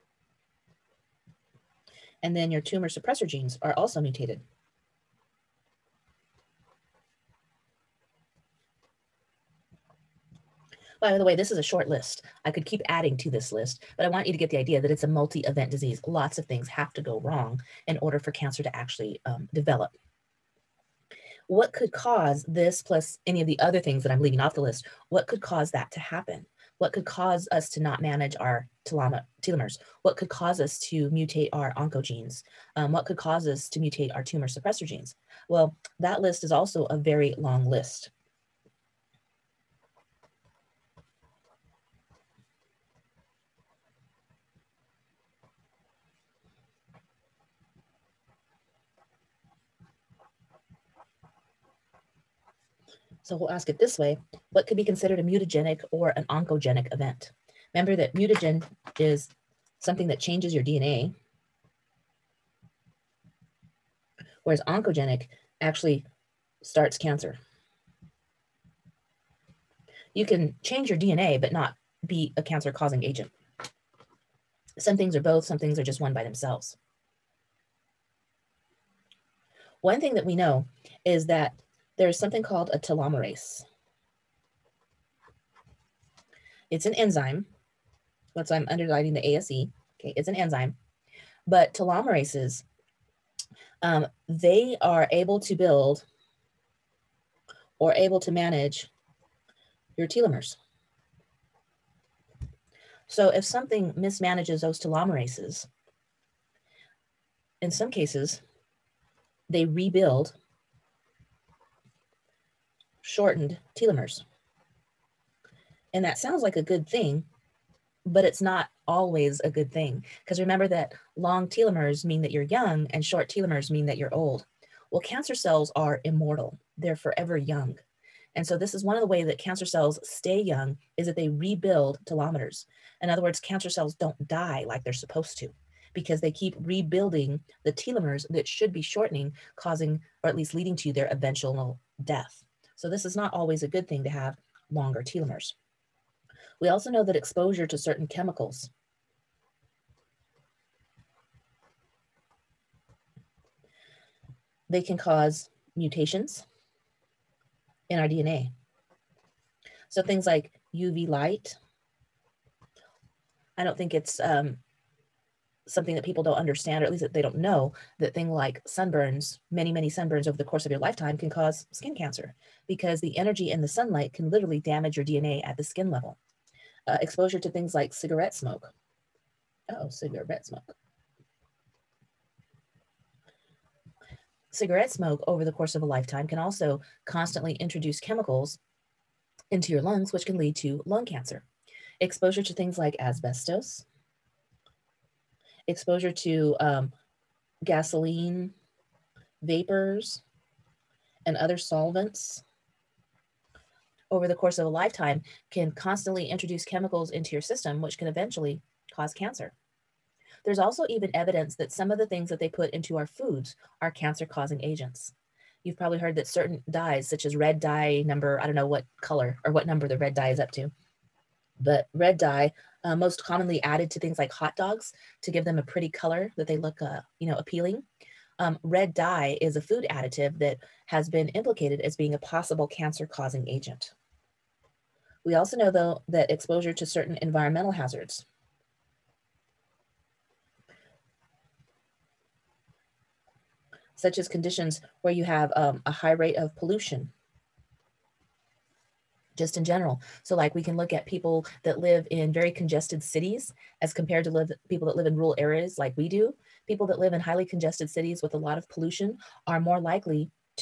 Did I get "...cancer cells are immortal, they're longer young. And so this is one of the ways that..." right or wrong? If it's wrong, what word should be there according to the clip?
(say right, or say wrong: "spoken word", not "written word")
wrong: "forever", not "longer".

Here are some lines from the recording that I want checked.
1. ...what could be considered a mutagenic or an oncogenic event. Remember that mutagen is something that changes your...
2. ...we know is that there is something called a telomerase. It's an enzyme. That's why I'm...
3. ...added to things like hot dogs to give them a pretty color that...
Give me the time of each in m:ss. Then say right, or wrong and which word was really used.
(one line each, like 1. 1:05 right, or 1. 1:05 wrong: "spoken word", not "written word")
1. 0:54 right
2. 1:20 right
3. 3:43 right.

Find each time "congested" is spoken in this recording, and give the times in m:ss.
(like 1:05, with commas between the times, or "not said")
4:12, 4:17.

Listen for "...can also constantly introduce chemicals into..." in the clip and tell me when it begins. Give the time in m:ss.
3:06.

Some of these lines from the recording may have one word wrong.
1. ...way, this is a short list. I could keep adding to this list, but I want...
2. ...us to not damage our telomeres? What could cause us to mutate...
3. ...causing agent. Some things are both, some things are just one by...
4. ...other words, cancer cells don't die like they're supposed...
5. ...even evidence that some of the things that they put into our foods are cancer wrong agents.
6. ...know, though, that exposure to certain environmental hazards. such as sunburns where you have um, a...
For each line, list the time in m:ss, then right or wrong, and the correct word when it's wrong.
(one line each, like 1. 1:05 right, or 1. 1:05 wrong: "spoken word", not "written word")
1. 0:11 right
2. 0:27 wrong: "manage", not "damage"
3. 1:12 right
4. 2:13 right
5. 3:30 wrong: "causing", not "wrong"
6. 3:55 wrong: "conditions", not "sunburns".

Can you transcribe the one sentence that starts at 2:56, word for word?
Uh, exposure to things like cigarette smoke.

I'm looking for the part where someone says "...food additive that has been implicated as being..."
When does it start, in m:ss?
3:49.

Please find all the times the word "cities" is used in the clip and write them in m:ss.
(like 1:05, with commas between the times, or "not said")
4:13, 4:17.